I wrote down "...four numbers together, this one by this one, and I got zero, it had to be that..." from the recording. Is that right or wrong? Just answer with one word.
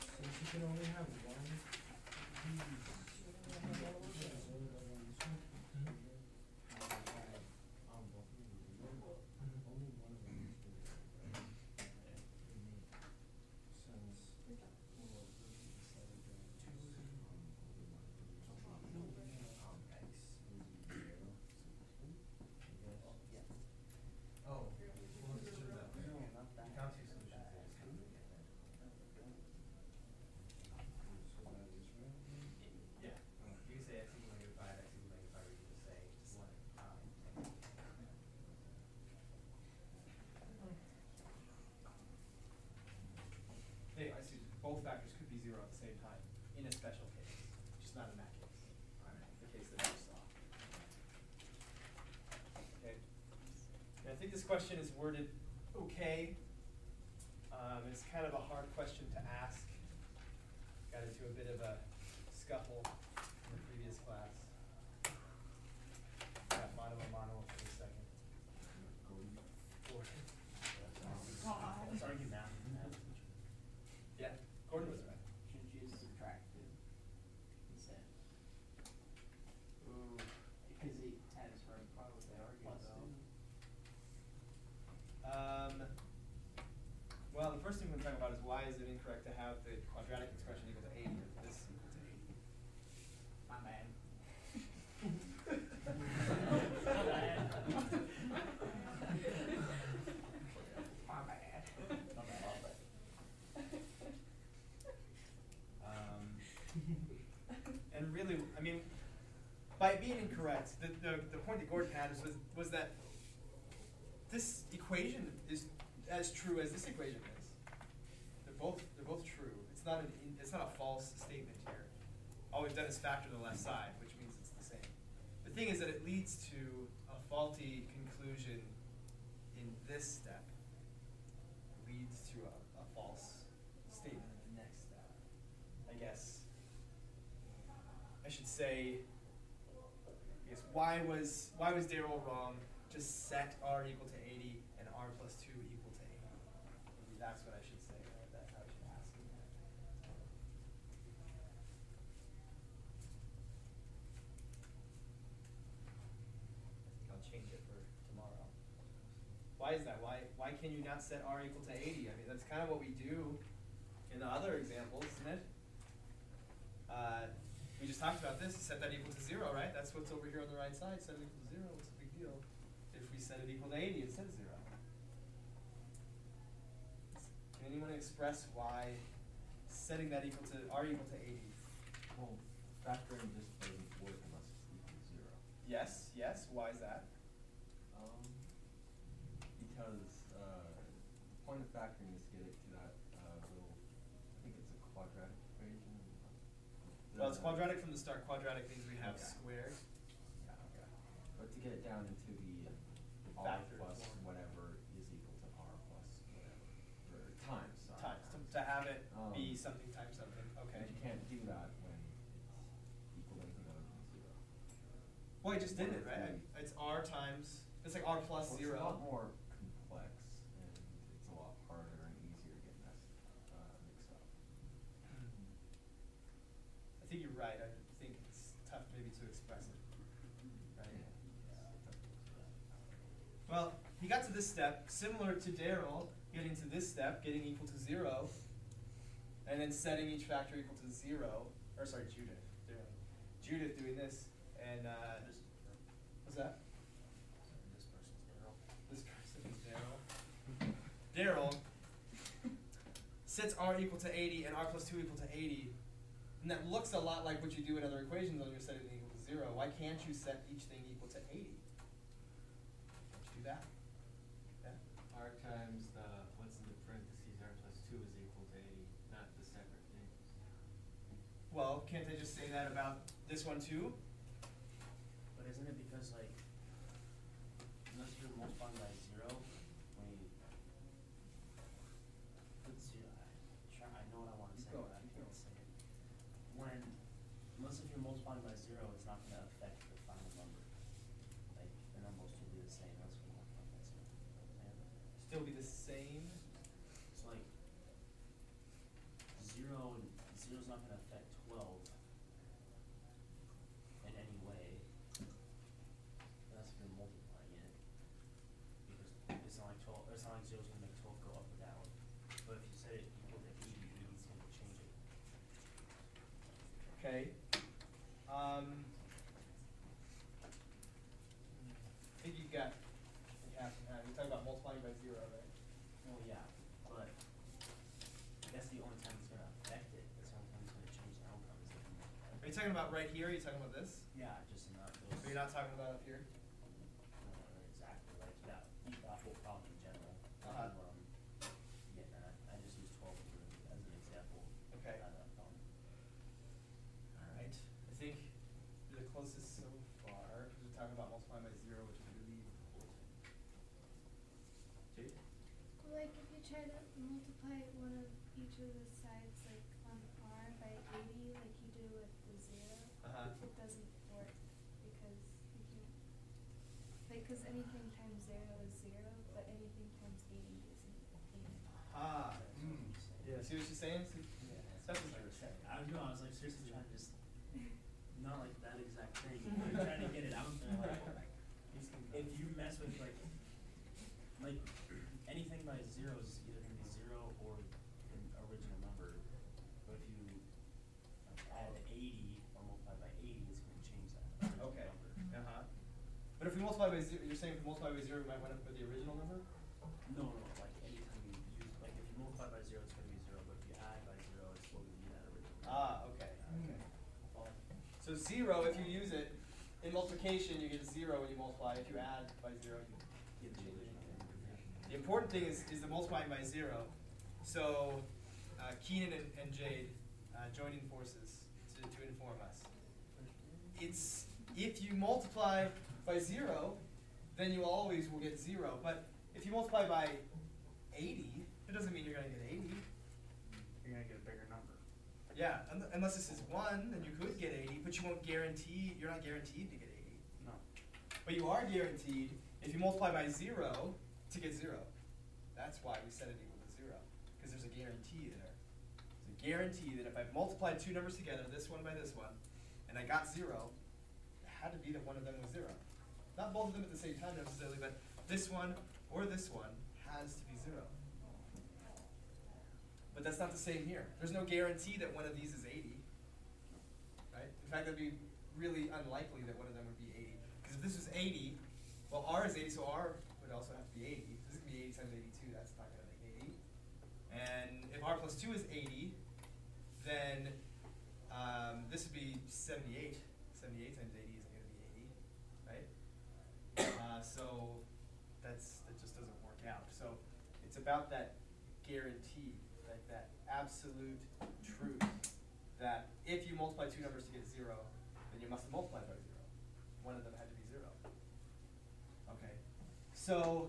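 wrong.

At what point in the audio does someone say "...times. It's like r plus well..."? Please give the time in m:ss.
3:37.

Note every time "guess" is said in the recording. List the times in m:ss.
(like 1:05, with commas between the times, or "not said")
2:15.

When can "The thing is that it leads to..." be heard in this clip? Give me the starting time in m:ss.
2:05.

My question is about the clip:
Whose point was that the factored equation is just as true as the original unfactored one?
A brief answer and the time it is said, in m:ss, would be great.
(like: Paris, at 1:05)
Gordon, at 1:51.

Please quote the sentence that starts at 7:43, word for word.
But that's not the same here.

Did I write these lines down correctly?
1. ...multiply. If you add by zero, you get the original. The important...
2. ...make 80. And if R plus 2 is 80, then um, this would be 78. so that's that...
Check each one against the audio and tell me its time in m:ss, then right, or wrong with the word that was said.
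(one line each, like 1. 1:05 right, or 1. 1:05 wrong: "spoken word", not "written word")
1. 6:51 right
2. 7:56 right.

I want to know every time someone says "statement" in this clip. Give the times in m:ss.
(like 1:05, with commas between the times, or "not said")
2:01, 2:13.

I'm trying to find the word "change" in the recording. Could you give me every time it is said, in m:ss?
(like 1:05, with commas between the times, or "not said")
2:37, 5:30.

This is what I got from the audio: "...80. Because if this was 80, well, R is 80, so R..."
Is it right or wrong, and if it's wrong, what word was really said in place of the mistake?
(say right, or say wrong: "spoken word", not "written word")
right.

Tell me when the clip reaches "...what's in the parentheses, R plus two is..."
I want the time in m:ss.
4:26.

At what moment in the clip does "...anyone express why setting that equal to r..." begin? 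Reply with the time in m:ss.
2:57.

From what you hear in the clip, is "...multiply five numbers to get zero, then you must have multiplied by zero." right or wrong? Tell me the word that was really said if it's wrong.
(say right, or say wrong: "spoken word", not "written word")
wrong: "two", not "five".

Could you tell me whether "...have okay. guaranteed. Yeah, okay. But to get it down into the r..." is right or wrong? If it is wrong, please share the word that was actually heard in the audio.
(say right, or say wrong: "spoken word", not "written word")
wrong: "squared", not "guaranteed".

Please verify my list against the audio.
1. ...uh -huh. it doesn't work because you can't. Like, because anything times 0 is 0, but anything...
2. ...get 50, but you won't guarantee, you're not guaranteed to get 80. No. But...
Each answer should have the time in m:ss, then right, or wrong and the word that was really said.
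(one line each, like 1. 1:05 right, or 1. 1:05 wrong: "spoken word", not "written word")
1. 6:03 right
2. 7:17 wrong: "80", not "50".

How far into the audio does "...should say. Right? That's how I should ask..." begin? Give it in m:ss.
2:27.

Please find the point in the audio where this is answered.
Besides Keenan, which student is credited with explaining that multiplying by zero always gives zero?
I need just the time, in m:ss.
6:59.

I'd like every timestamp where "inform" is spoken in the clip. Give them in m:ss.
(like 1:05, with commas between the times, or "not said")
7:02.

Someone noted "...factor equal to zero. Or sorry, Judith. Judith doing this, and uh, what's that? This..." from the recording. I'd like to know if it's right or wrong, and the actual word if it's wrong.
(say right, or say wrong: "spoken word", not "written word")
right.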